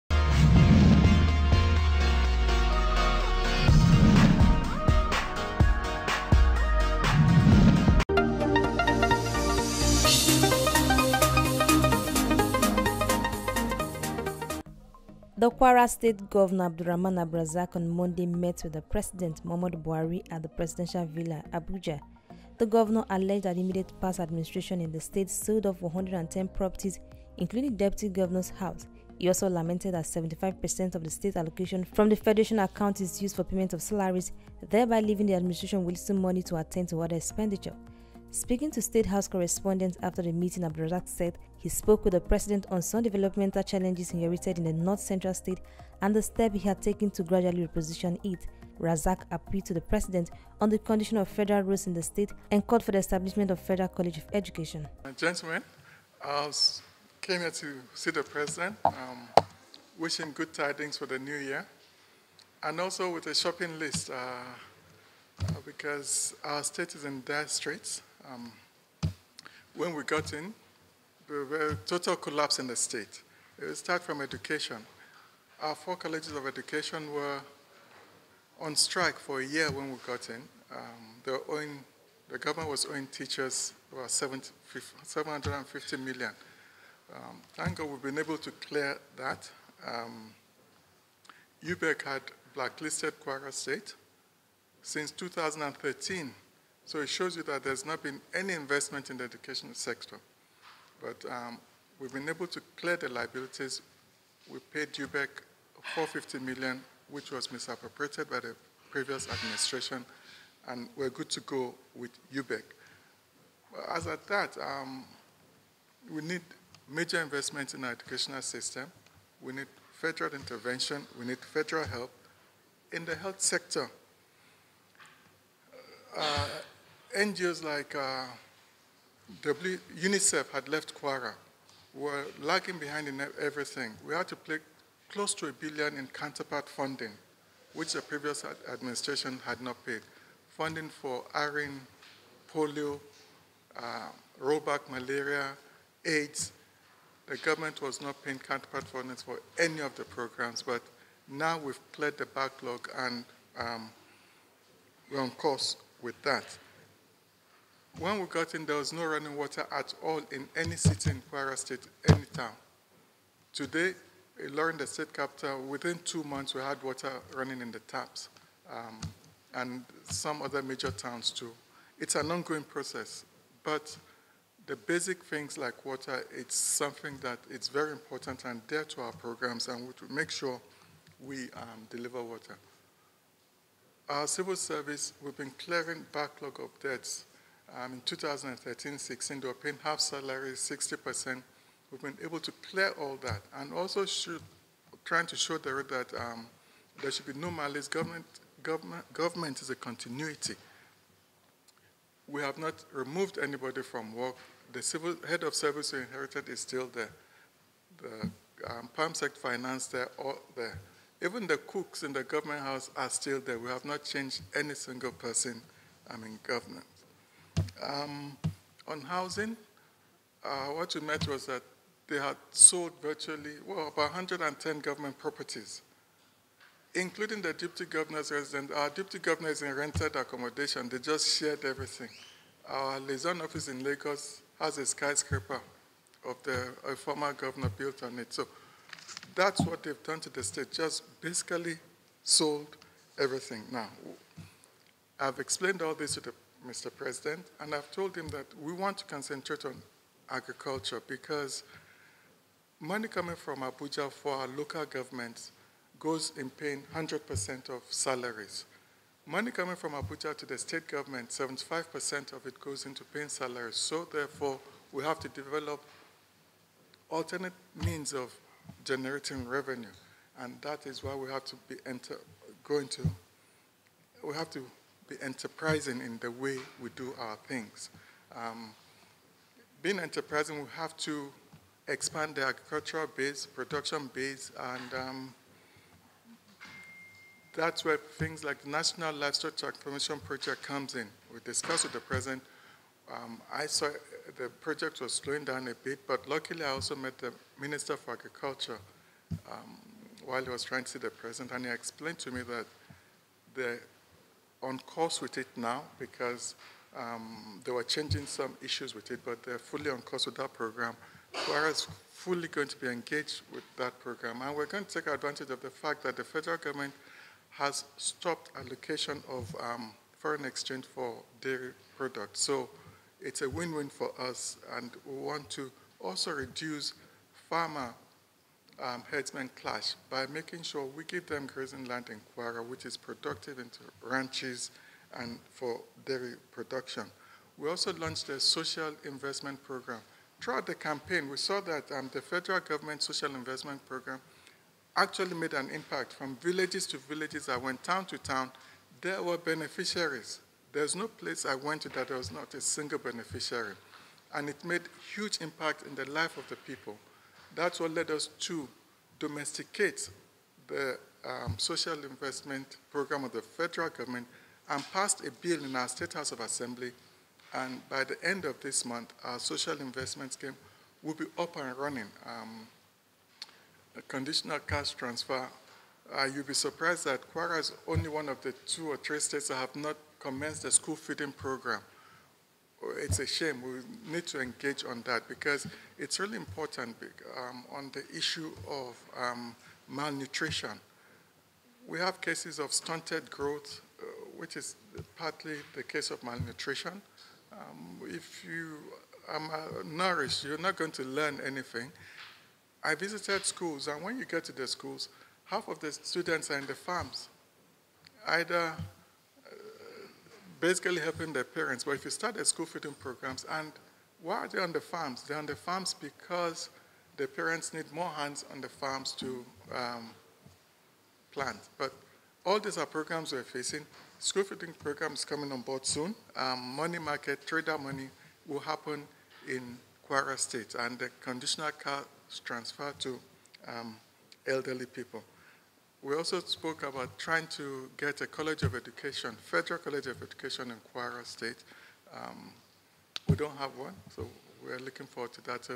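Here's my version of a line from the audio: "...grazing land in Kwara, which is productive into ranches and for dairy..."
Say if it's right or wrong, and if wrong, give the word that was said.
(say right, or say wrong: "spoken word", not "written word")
right.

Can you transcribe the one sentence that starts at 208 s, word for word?
The um, sector finance there, all there.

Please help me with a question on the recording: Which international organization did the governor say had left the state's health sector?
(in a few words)
UNICEF.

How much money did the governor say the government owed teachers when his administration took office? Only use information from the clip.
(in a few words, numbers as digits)
750 million.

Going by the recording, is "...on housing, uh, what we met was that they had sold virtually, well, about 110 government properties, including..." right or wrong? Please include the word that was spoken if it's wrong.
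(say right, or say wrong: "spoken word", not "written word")
right.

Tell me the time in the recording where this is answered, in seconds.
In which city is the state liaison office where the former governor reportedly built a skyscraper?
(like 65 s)
233 s.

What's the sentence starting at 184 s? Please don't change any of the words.
Our civil service, we've been clearing backlog of debts um, in 2013-16, they were paying half salaries, 60%.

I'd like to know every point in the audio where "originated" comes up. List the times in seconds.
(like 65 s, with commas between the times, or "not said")
not said.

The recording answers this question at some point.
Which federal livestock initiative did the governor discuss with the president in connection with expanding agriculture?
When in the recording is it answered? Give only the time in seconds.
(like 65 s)
288 s.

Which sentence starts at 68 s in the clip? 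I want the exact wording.
Um, when we got in, there were total collapse in the state.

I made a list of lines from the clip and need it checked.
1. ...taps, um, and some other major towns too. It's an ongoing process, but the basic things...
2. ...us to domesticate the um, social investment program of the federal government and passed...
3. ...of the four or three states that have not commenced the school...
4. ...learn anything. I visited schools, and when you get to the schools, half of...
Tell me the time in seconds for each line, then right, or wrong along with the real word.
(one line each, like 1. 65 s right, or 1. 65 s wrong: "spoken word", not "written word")
1. 167 s right
2. 358 s right
3. 378 s wrong: "two", not "four"
4. 401 s right.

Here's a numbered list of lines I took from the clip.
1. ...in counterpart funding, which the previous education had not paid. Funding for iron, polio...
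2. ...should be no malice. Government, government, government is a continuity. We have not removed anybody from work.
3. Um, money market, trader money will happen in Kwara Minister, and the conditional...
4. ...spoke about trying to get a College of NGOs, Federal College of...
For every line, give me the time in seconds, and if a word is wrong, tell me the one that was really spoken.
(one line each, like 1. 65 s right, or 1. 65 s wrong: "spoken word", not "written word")
1. 135 s wrong: "administration", not "education"
2. 197 s right
3. 426 s wrong: "State", not "Minister"
4. 436 s wrong: "Education", not "NGOs".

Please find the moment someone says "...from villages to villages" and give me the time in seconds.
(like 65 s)
346 s.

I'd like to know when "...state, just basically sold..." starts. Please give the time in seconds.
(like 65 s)
240 s.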